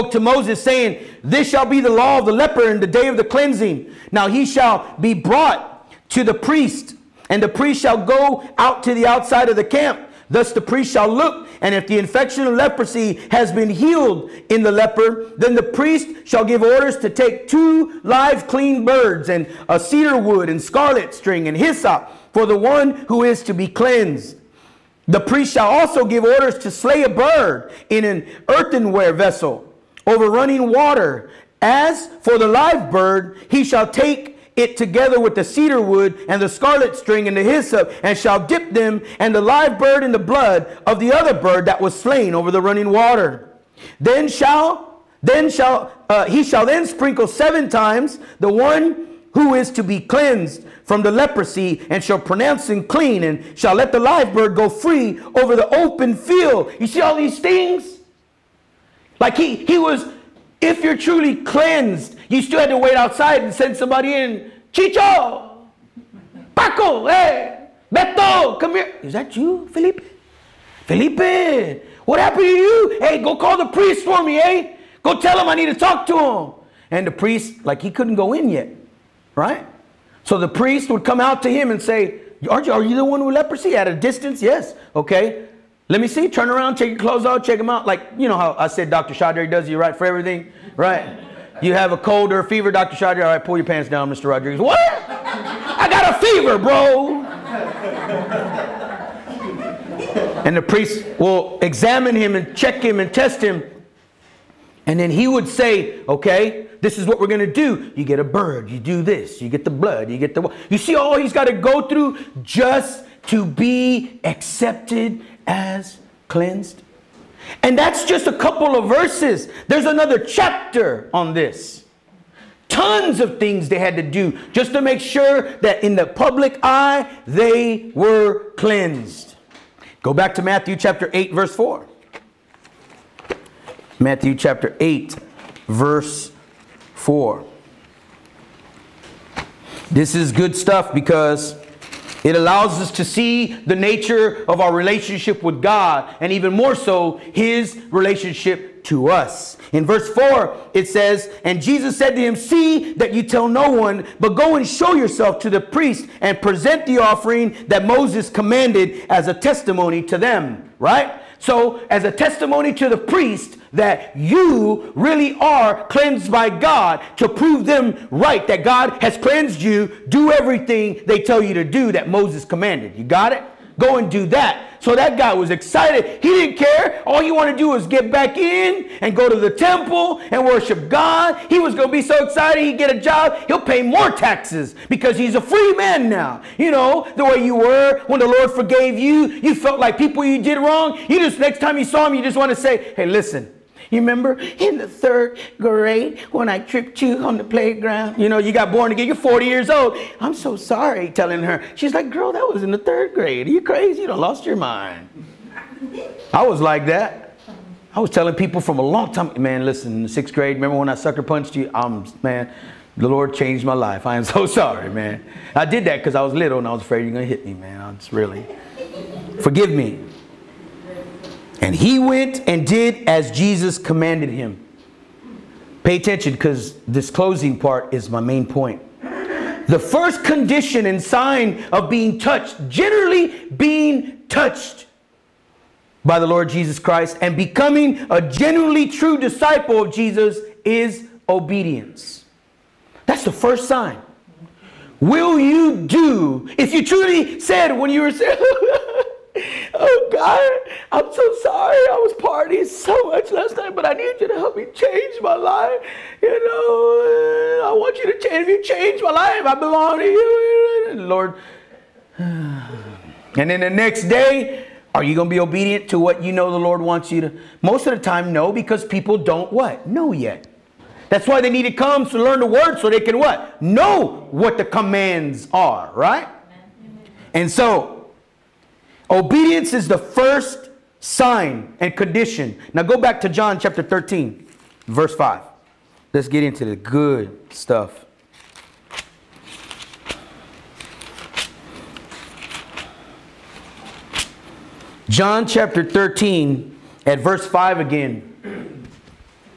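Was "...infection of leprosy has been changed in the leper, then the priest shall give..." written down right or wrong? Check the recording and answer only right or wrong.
wrong.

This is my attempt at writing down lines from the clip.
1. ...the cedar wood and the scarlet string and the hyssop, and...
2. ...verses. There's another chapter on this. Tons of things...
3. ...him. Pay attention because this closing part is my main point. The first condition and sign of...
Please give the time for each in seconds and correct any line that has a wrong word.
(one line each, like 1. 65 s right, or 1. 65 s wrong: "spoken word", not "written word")
1. 35 s right
2. 118 s right
3. 224 s right.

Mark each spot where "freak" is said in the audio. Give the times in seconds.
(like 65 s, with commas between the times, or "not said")
not said.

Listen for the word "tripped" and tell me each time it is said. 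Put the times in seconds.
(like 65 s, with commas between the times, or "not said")
196 s.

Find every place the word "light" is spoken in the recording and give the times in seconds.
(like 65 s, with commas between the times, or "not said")
not said.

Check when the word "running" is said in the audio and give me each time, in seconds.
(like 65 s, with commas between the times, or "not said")
30 s, 42 s.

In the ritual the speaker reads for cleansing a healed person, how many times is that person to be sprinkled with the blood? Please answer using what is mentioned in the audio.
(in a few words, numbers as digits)
7.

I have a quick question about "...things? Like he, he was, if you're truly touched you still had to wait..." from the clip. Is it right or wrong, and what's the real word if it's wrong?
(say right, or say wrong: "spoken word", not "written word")
wrong: "cleansed", not "touched".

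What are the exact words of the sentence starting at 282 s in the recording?
Now go back to John chapter 13, verse 5.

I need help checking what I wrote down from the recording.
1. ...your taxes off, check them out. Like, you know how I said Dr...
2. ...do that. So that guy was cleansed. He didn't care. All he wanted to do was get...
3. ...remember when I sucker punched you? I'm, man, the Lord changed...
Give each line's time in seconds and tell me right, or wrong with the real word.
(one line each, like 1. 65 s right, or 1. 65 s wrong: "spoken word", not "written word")
1. 86 s wrong: "clothes", not "taxes"
2. 174 s wrong: "excited", not "cleansed"
3. 210 s right.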